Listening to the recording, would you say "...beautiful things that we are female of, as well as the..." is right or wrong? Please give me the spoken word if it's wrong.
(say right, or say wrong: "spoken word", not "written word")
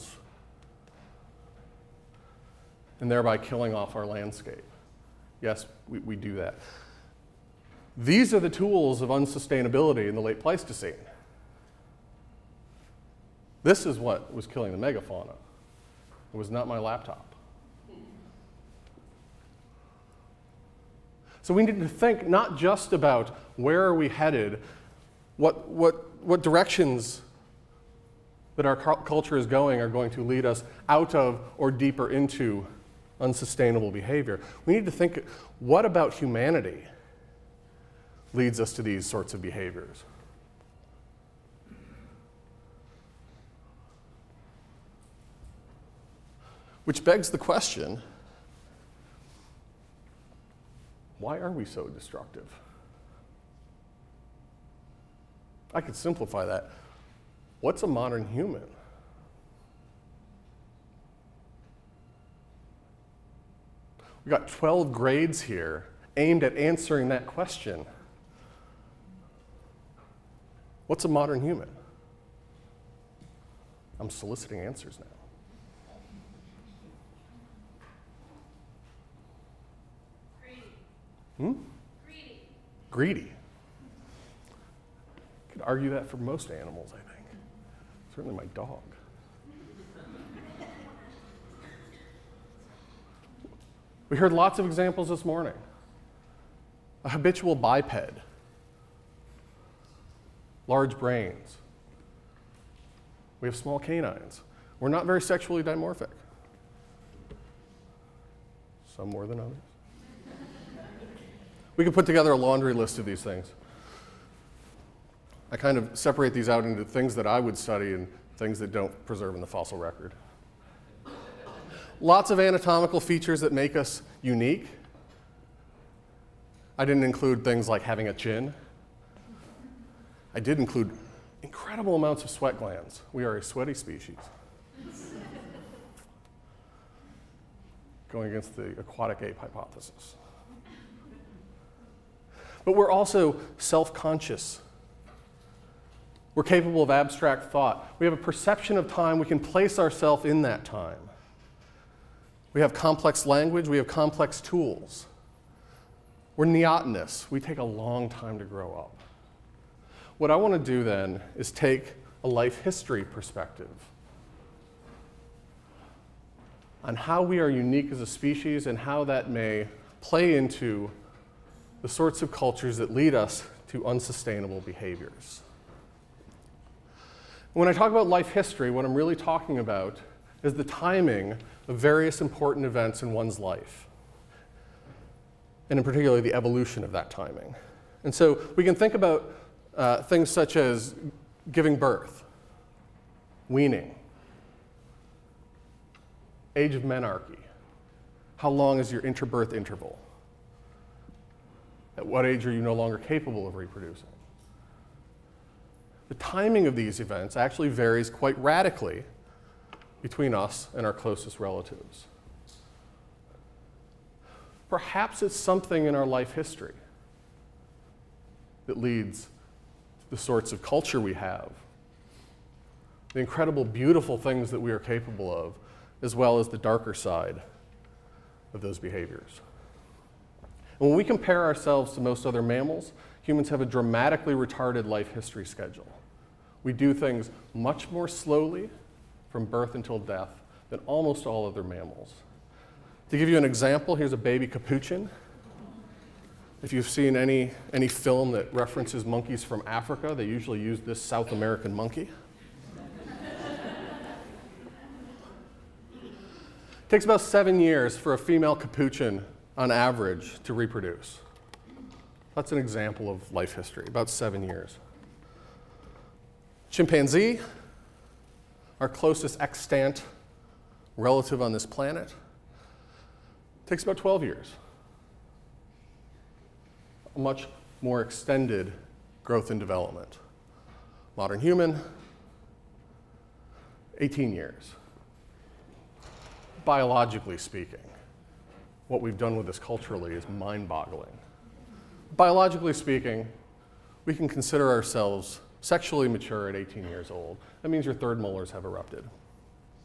wrong: "capable", not "female".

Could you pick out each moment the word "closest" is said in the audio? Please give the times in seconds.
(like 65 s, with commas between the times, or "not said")
210 s, 268 s.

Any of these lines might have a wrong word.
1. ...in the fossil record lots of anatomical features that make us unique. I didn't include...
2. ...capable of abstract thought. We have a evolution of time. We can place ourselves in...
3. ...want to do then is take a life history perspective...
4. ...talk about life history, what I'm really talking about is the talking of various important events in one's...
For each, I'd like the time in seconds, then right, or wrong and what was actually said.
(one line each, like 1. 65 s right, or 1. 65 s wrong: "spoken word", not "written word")
1. 119 s right
2. 146 s wrong: "perception", not "evolution"
3. 160 s right
4. 177 s wrong: "timing", not "talking".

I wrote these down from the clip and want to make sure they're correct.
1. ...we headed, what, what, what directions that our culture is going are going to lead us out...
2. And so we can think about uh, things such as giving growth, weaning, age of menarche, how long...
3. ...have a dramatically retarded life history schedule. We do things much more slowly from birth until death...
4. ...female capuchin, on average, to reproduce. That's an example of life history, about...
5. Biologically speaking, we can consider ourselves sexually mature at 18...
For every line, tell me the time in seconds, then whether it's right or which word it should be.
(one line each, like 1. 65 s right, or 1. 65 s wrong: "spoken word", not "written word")
1. 23 s right
2. 188 s wrong: "birth", not "growth"
3. 233 s right
4. 258 s right
5. 292 s right.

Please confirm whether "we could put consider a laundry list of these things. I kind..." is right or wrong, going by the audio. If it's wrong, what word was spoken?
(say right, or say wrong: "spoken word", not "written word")
wrong: "together", not "consider".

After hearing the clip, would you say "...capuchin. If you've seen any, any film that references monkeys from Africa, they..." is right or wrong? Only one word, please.
right.